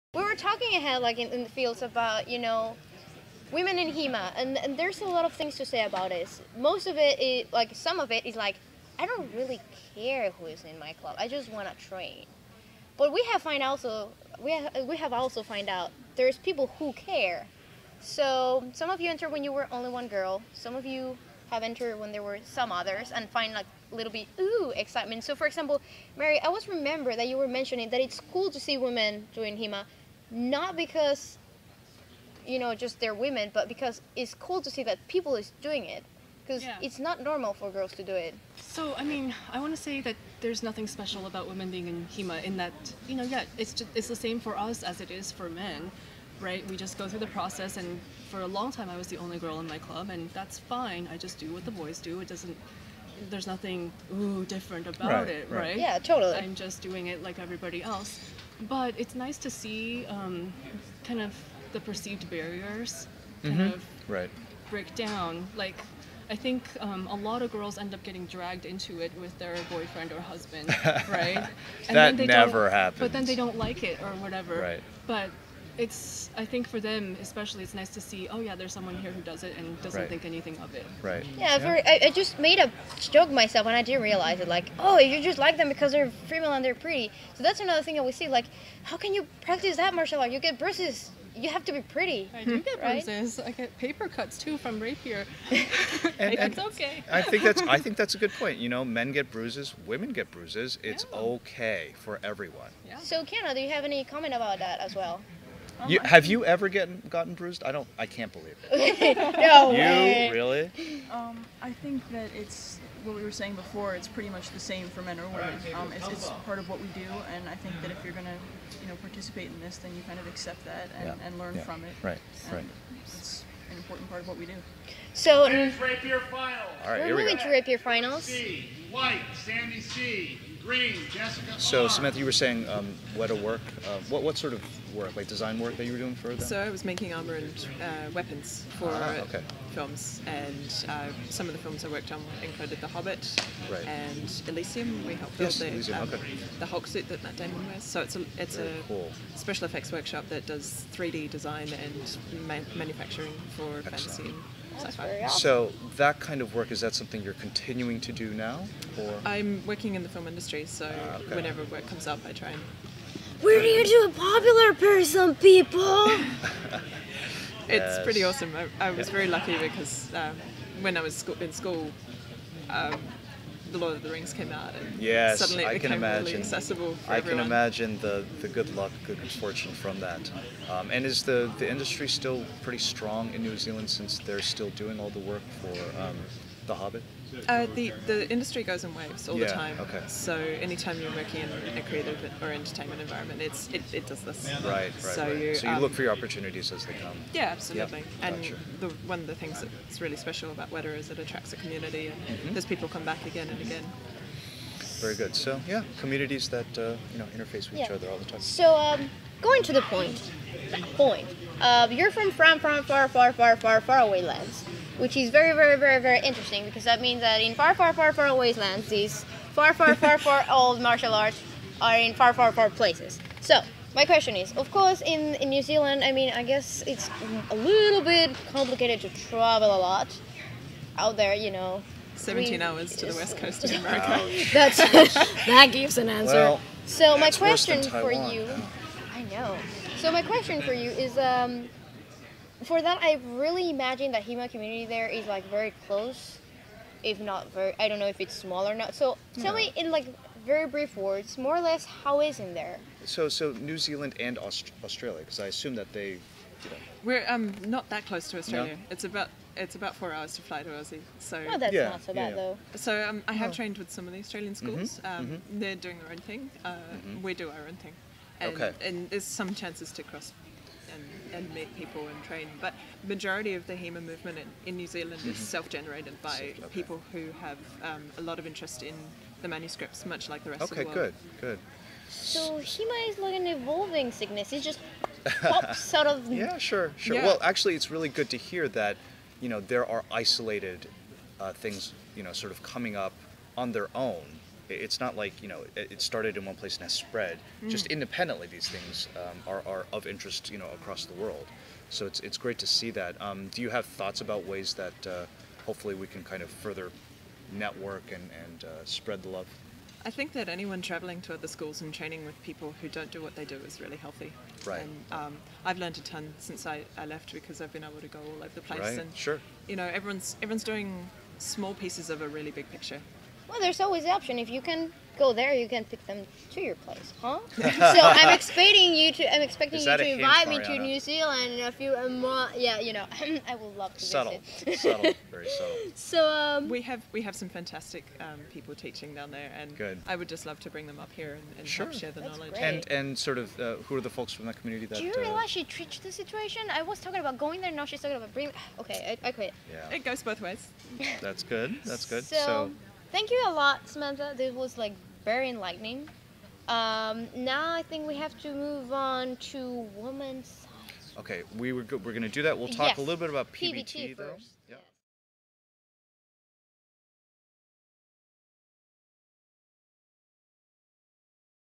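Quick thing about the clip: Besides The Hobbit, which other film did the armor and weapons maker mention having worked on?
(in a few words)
Elysium.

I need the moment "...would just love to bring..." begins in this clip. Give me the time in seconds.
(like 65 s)
340 s.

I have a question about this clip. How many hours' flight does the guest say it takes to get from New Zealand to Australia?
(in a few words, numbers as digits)
4.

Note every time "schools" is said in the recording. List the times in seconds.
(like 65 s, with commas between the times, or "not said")
171 s, 264 s, 311 s.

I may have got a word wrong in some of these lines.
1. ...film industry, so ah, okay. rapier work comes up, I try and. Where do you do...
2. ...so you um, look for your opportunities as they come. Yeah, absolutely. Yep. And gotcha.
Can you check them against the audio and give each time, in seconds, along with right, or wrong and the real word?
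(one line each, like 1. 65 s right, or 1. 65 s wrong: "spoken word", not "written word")
1. 160 s wrong: "whenever", not "rapier"
2. 195 s right.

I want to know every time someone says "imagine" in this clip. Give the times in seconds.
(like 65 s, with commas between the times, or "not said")
177 s, 243 s.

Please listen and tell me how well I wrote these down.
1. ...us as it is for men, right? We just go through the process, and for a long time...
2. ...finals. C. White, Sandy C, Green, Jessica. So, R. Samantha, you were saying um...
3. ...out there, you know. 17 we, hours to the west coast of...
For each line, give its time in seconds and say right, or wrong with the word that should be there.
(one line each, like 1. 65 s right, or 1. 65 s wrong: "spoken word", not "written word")
1. 44 s right
2. 127 s right
3. 230 s right.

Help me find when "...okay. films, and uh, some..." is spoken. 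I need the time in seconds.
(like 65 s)
139 s.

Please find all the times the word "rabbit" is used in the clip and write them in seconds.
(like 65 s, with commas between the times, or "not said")
not said.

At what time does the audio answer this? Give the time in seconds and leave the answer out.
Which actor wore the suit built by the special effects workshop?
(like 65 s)
147 s.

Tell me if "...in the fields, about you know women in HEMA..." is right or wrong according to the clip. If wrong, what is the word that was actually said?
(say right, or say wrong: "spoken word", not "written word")
right.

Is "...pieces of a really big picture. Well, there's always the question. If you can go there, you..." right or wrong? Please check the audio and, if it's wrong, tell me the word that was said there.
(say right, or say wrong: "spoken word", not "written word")
wrong: "option", not "question".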